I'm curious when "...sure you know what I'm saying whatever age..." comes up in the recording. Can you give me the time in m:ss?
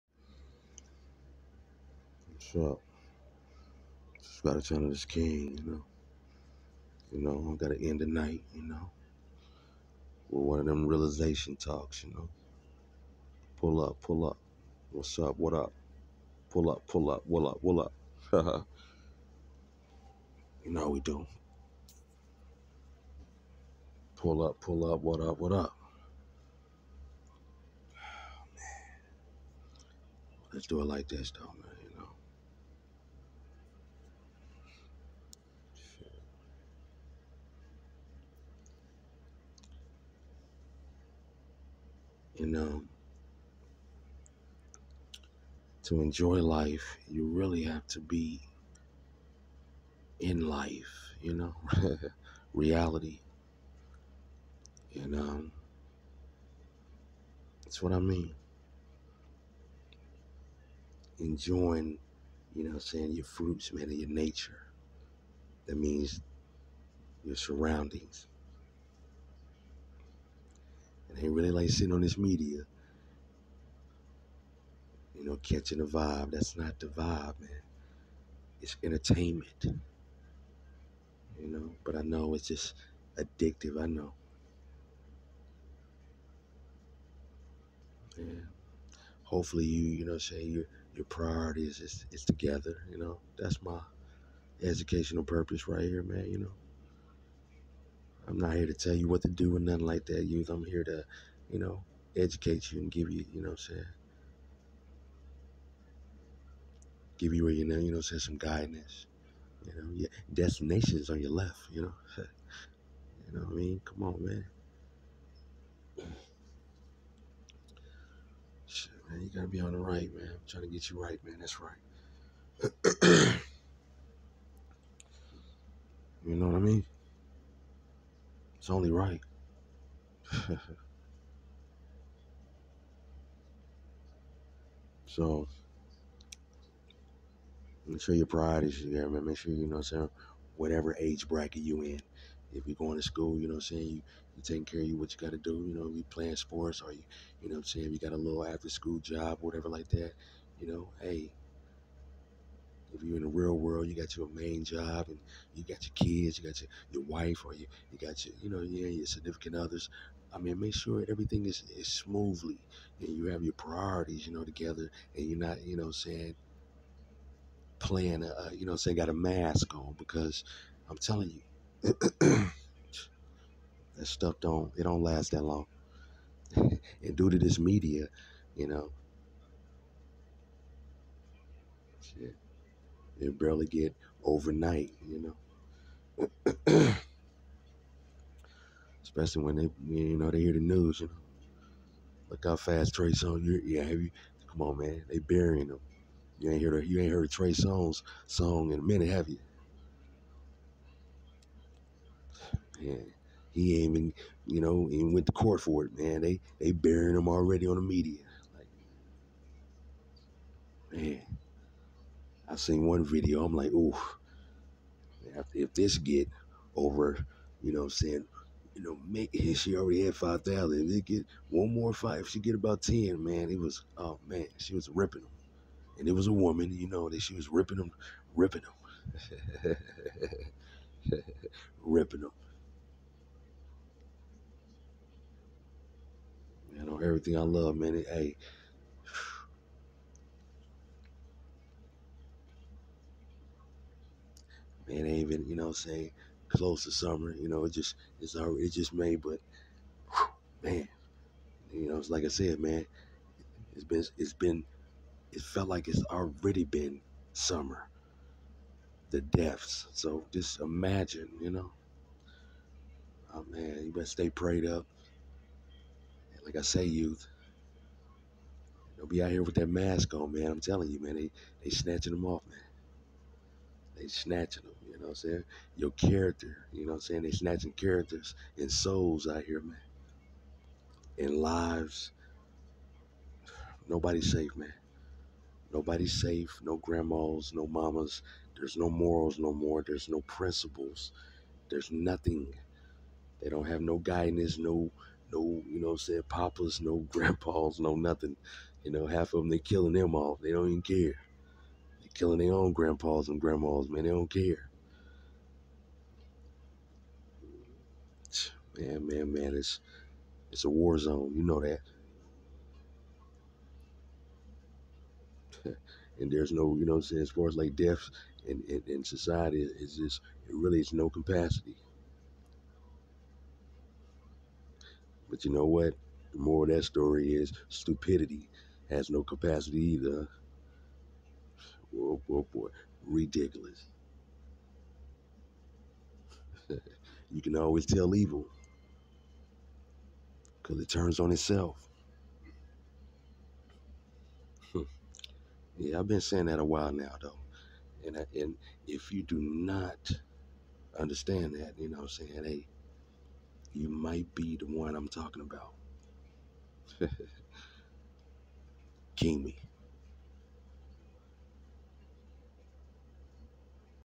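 2:19.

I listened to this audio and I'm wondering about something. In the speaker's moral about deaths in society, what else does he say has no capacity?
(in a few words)
stupidity.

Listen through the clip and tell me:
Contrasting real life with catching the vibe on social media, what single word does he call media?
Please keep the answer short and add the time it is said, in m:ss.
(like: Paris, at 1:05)
entertainment, at 1:18.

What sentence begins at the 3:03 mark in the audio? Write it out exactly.
It barely get overnight, you know.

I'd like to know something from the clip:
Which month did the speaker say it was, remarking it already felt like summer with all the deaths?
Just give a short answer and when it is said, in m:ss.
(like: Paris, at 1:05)
May, at 4:08.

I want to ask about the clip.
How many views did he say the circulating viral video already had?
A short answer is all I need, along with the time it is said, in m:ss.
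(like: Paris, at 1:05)
5000, at 3:40.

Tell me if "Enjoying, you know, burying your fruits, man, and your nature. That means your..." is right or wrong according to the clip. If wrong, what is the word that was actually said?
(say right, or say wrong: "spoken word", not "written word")
wrong: "saying", not "burying".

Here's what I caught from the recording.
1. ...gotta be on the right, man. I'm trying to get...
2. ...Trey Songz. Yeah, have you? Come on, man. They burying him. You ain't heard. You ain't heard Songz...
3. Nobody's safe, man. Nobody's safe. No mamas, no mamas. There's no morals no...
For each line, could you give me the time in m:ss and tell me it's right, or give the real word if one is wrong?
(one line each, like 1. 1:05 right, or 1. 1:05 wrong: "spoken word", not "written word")
1. 1:59 right
2. 3:12 wrong: "Trey", not "Songz"
3. 4:43 wrong: "grandmas", not "mamas".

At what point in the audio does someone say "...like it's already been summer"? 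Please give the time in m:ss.
4:15.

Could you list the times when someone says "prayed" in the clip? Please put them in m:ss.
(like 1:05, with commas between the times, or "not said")
4:24.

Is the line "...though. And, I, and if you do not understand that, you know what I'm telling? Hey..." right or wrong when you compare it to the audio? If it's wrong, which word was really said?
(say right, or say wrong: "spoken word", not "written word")
wrong: "saying", not "telling".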